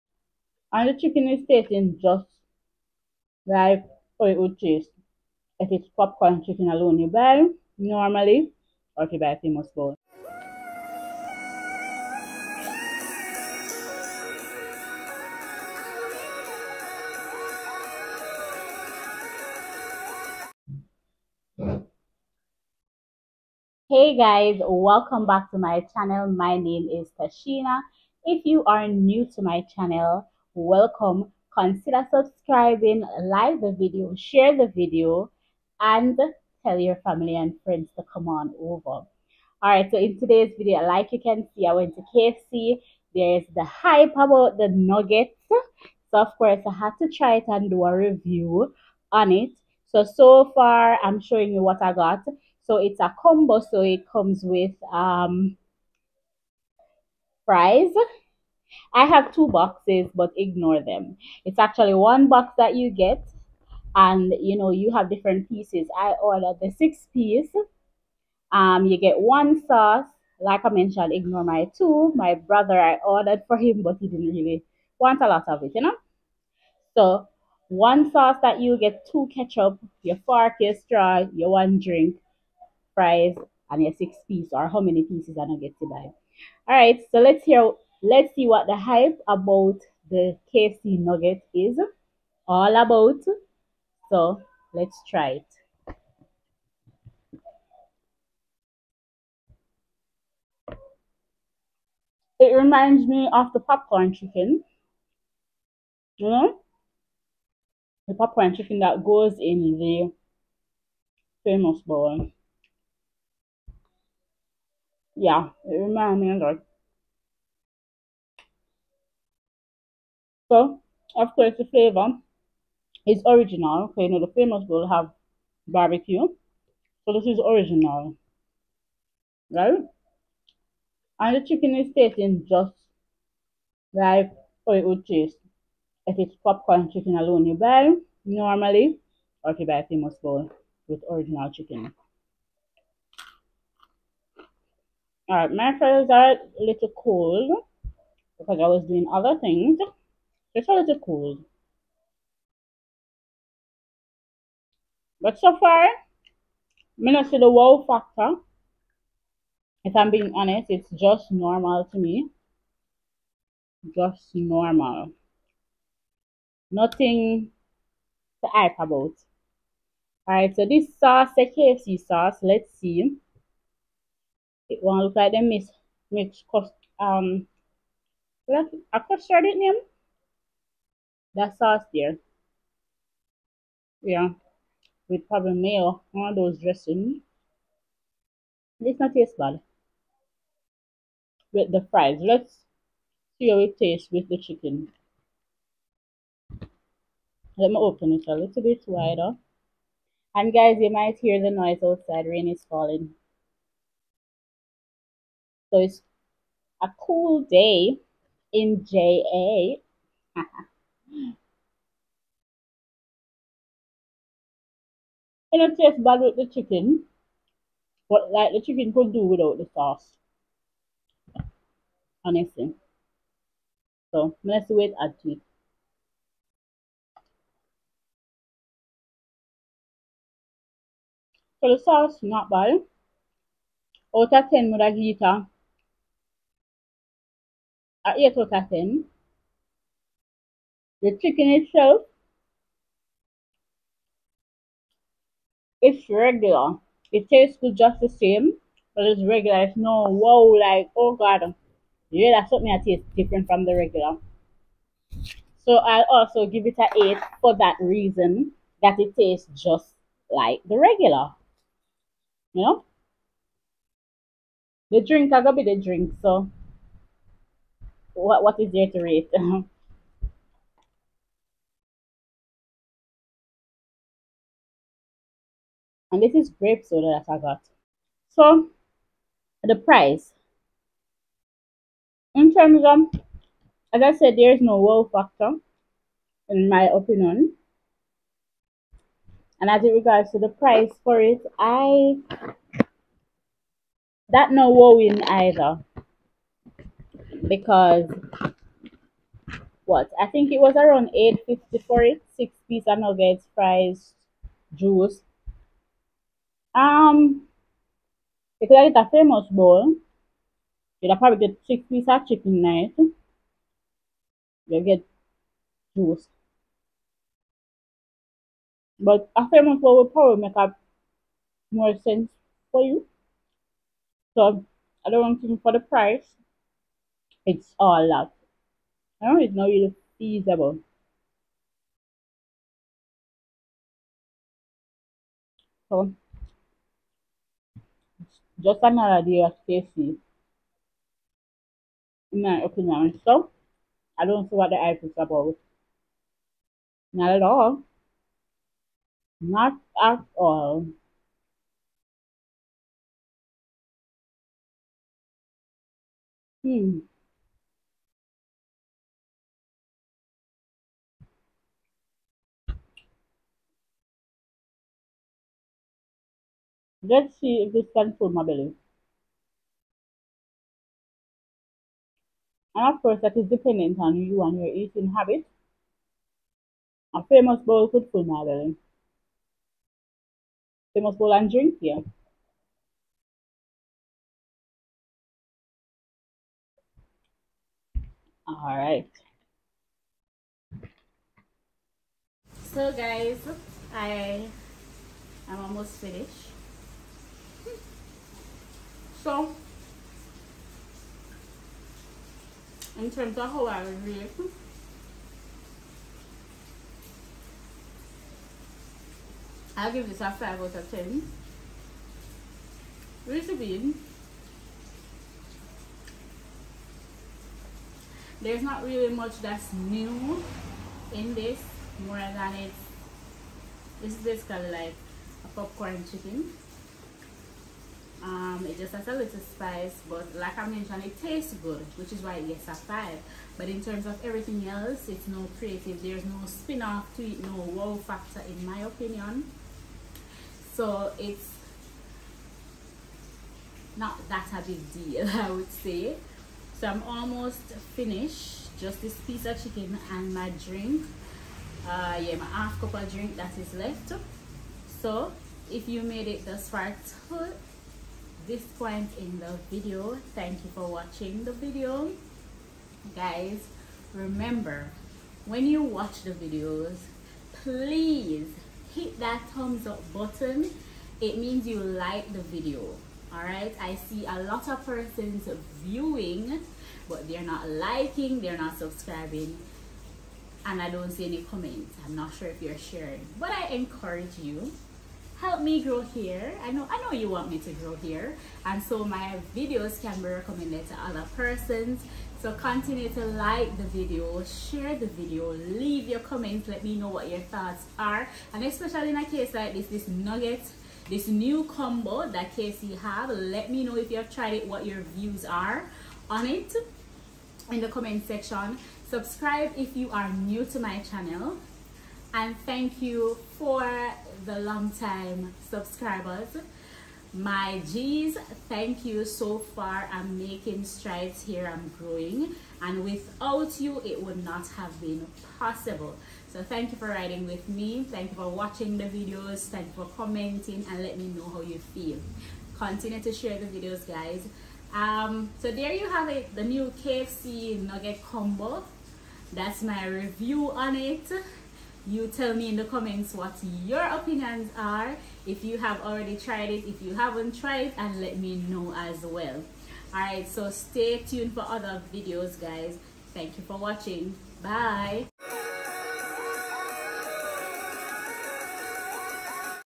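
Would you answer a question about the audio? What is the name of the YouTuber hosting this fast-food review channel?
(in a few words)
Tasheena.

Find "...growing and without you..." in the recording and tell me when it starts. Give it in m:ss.
8:41.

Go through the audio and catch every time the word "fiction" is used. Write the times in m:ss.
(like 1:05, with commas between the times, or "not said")
not said.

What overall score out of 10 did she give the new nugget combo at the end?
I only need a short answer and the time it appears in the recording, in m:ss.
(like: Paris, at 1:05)
5, at 6:50.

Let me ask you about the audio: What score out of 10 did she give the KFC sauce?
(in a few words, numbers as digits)
8.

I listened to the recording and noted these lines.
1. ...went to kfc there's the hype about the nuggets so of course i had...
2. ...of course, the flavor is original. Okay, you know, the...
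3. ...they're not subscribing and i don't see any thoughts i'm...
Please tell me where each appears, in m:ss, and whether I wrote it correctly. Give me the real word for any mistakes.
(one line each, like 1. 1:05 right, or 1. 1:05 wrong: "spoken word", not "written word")
1. 0:41 right
2. 2:01 right
3. 7:58 wrong: "comments", not "thoughts".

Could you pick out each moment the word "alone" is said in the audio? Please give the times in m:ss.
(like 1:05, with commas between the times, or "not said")
0:06, 2:17.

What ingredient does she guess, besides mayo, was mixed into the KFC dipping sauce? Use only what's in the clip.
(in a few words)
custard.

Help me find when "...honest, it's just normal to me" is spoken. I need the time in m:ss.
2:40.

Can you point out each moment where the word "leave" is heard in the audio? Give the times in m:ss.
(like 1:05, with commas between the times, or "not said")
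8:15.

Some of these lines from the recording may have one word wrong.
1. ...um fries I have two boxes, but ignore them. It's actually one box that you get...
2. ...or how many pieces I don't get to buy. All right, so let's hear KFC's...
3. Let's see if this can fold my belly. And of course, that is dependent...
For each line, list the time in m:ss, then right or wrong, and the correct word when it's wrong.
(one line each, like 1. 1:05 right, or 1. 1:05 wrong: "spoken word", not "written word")
1. 0:54 right
2. 1:24 wrong: "Let", not "KFC"
3. 6:07 right.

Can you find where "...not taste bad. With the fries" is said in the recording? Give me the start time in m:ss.
3:08.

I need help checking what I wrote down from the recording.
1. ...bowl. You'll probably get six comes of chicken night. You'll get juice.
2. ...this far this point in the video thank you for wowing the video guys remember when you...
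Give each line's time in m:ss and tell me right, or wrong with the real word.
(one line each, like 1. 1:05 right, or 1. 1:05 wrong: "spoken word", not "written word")
1. 5:09 wrong: "pieces", not "comes"
2. 7:36 wrong: "watching", not "wowing".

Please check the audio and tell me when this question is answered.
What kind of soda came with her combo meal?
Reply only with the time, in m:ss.
4:36.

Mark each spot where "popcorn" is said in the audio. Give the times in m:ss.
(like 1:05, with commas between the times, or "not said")
0:05, 1:43, 1:48, 2:16, 7:05.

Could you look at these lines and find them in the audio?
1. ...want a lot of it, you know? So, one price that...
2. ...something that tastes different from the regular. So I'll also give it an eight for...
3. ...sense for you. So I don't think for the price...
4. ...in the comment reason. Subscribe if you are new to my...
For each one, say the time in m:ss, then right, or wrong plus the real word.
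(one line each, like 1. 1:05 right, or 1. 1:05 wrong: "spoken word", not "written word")
1. 1:14 wrong: "sauce", not "price"
2. 4:12 right
3. 5:21 right
4. 8:27 wrong: "section", not "reason".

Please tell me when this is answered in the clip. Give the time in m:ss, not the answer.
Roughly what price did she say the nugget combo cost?
5:01.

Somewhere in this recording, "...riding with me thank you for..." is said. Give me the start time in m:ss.
8:47.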